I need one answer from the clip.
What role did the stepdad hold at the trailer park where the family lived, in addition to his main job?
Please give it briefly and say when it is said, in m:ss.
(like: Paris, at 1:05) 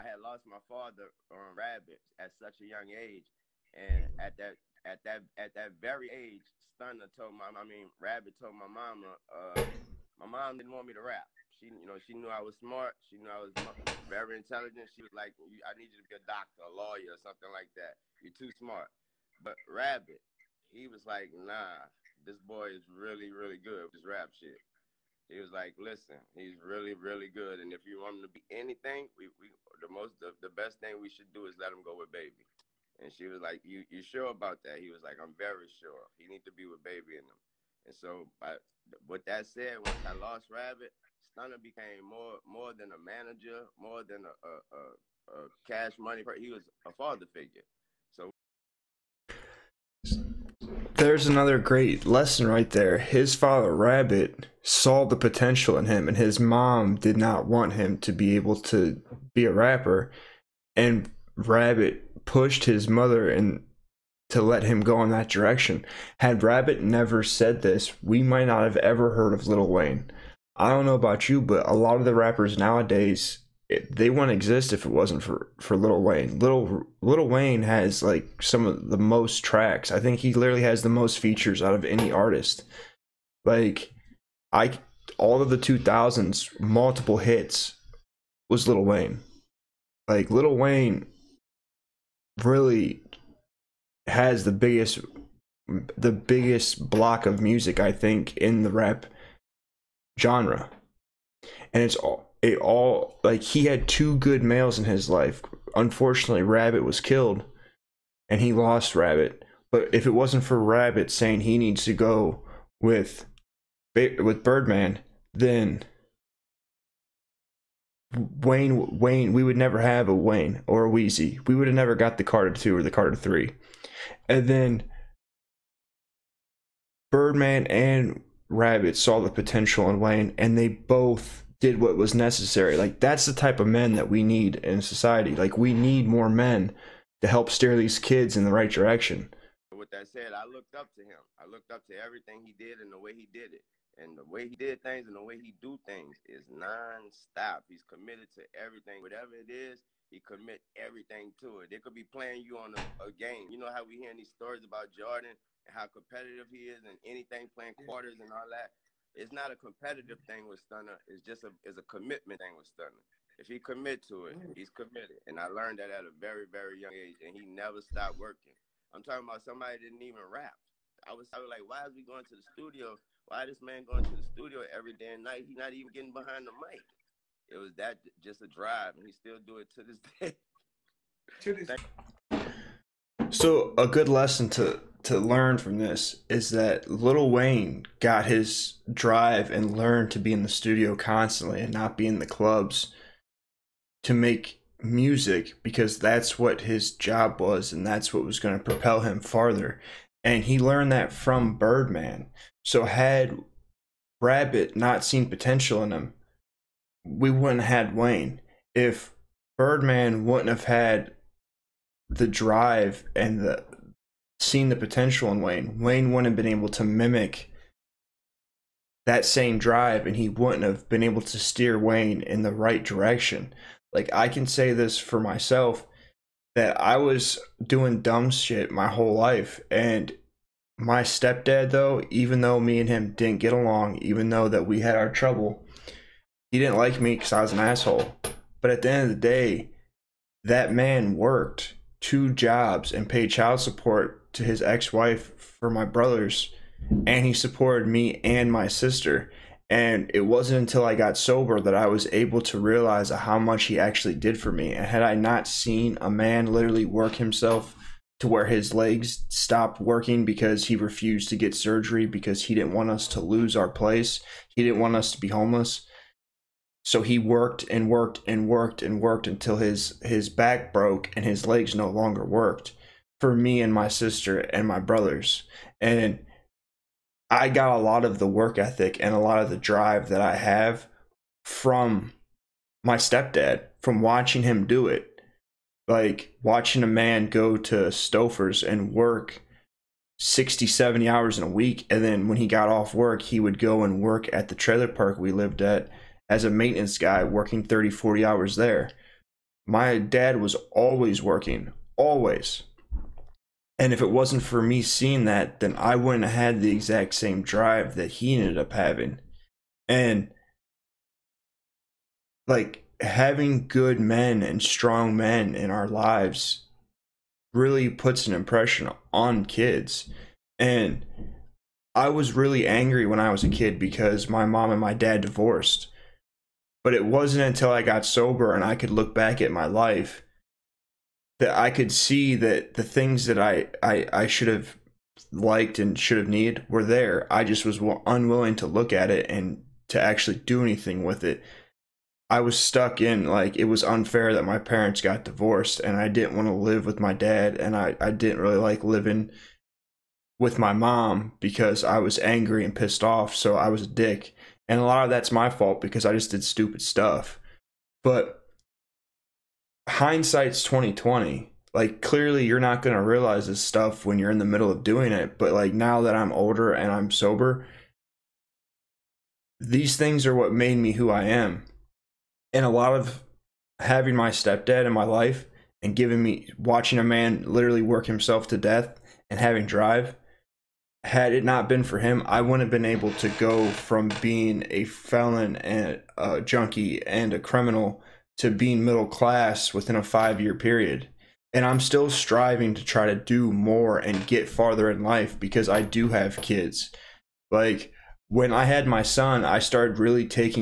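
maintenance guy, at 4:56.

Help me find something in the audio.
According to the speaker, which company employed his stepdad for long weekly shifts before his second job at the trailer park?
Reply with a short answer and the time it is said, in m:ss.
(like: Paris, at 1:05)
Stouffer's, at 4:47.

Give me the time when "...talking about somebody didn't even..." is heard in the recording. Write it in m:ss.
2:49.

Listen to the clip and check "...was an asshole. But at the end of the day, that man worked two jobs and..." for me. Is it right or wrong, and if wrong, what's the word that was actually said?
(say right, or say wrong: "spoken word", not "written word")
right.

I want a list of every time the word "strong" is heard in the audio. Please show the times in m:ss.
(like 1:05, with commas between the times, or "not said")
5:14.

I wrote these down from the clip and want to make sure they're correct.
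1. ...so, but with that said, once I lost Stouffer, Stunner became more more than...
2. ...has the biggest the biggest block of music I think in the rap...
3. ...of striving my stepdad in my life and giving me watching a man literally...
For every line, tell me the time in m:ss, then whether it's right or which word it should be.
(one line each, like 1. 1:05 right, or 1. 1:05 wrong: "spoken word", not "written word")
1. 0:37 wrong: "Rabbit", not "Stouffer"
2. 1:34 right
3. 6:12 wrong: "having", not "striving".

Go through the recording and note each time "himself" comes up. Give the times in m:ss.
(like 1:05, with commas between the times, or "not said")
4:17, 6:18.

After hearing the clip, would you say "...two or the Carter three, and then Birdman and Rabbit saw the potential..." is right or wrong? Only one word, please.
right.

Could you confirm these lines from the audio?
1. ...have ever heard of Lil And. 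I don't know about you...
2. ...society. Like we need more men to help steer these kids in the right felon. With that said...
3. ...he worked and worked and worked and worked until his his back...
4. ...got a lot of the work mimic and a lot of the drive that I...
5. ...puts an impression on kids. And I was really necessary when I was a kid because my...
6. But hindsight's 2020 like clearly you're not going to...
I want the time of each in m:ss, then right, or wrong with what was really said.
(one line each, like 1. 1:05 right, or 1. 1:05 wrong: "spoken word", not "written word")
1. 1:08 wrong: "Wayne", not "And"
2. 2:14 wrong: "direction", not "felon"
3. 4:27 right
4. 4:37 wrong: "ethic", not "mimic"
5. 5:17 wrong: "angry", not "necessary"
6. 5:58 right.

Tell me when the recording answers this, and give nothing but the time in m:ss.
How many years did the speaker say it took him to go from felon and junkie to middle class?
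6:30.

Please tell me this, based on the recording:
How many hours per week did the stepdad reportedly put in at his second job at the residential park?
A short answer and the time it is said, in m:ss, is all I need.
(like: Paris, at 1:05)
30 to 40, at 4:57.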